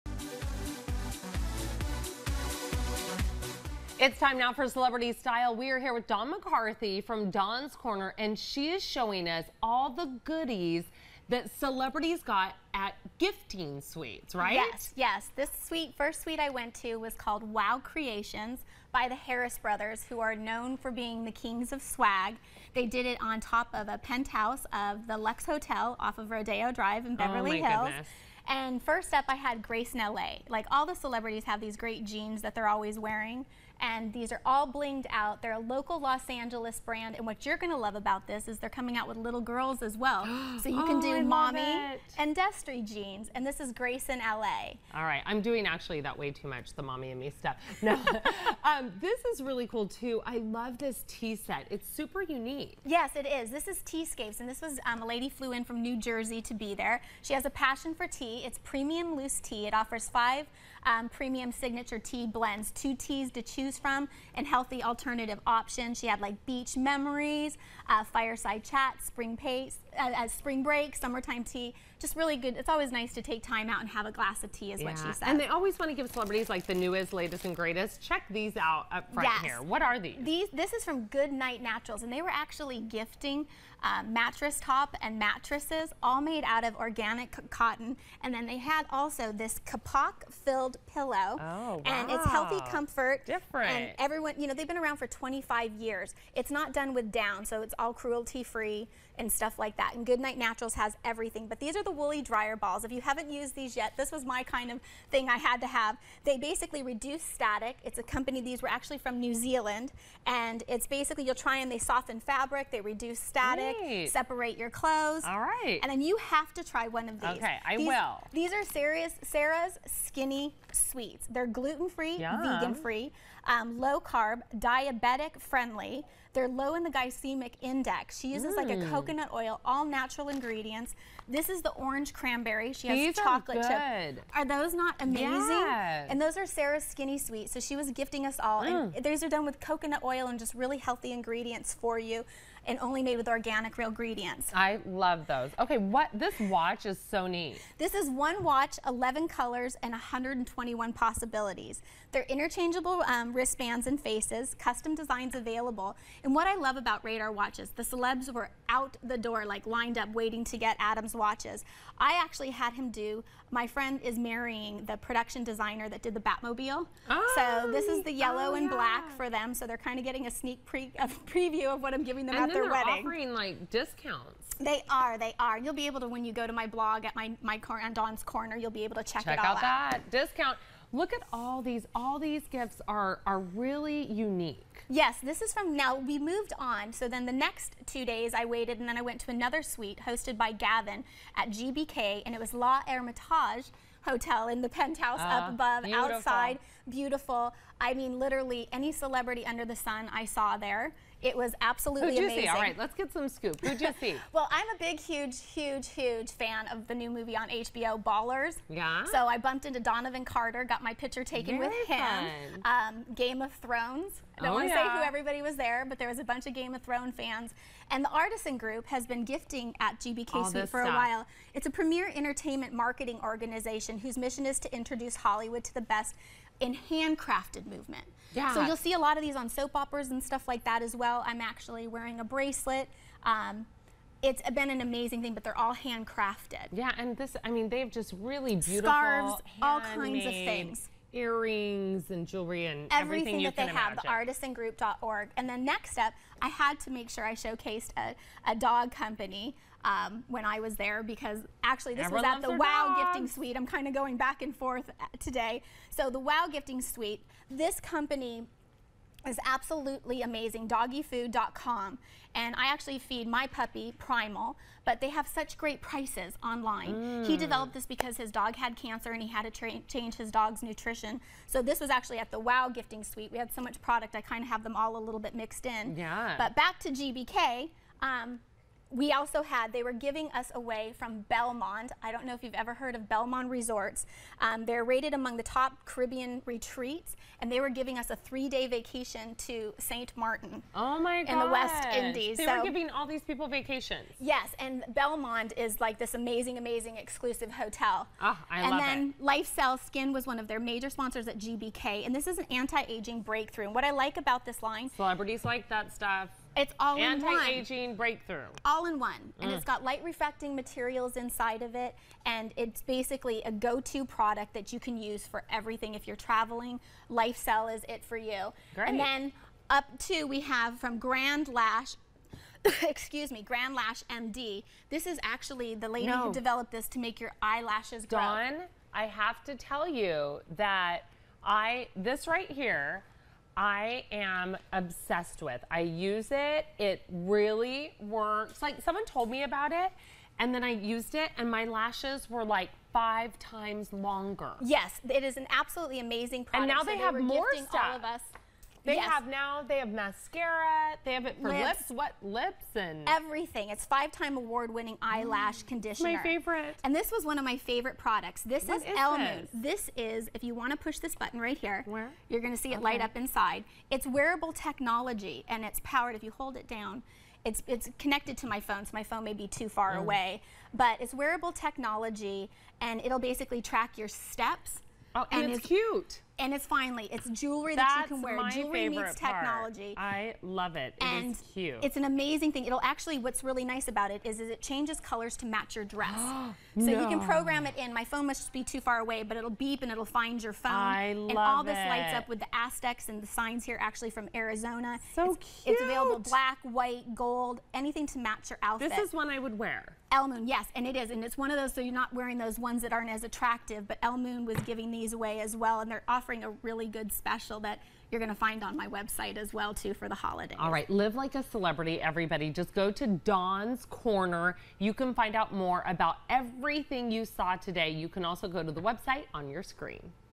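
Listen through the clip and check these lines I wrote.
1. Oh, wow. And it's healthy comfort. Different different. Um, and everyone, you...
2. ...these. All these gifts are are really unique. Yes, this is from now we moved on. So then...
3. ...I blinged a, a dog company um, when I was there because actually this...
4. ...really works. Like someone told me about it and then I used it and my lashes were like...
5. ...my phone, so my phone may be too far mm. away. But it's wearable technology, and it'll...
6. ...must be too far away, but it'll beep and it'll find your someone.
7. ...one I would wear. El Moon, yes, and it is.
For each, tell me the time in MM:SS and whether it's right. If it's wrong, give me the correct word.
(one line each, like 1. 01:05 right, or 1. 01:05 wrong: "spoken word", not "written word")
1. 01:31 right
2. 03:01 right
3. 04:07 wrong: "showcased", not "blinged"
4. 05:37 right
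5. 06:08 right
6. 06:28 wrong: "phone", not "someone"
7. 06:39 right.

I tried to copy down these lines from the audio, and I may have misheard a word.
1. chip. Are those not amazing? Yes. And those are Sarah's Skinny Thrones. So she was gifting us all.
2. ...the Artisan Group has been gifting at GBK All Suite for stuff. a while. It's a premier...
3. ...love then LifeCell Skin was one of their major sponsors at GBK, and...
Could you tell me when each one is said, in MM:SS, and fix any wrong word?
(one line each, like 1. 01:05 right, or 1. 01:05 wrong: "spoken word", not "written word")
1. 02:14 wrong: "Sweet", not "Thrones"
2. 03:38 right
3. 04:58 right.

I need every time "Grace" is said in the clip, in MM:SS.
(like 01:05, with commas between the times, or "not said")
00:29, 00:43.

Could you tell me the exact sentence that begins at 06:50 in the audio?
All right, live like a celebrity, everybody.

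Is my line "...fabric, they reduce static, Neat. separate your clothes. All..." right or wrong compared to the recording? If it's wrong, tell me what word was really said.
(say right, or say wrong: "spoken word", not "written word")
right.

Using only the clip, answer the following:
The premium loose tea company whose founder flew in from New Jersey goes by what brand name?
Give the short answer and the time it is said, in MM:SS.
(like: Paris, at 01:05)
Teascapes, at 00:53.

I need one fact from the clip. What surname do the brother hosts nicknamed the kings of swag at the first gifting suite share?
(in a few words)
Harris.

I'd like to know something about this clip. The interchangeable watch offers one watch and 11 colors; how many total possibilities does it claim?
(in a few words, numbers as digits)
121.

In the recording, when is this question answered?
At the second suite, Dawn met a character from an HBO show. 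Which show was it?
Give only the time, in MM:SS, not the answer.
03:28.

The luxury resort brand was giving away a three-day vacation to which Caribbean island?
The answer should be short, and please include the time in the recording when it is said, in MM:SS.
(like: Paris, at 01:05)
St. Martin, at 04:49.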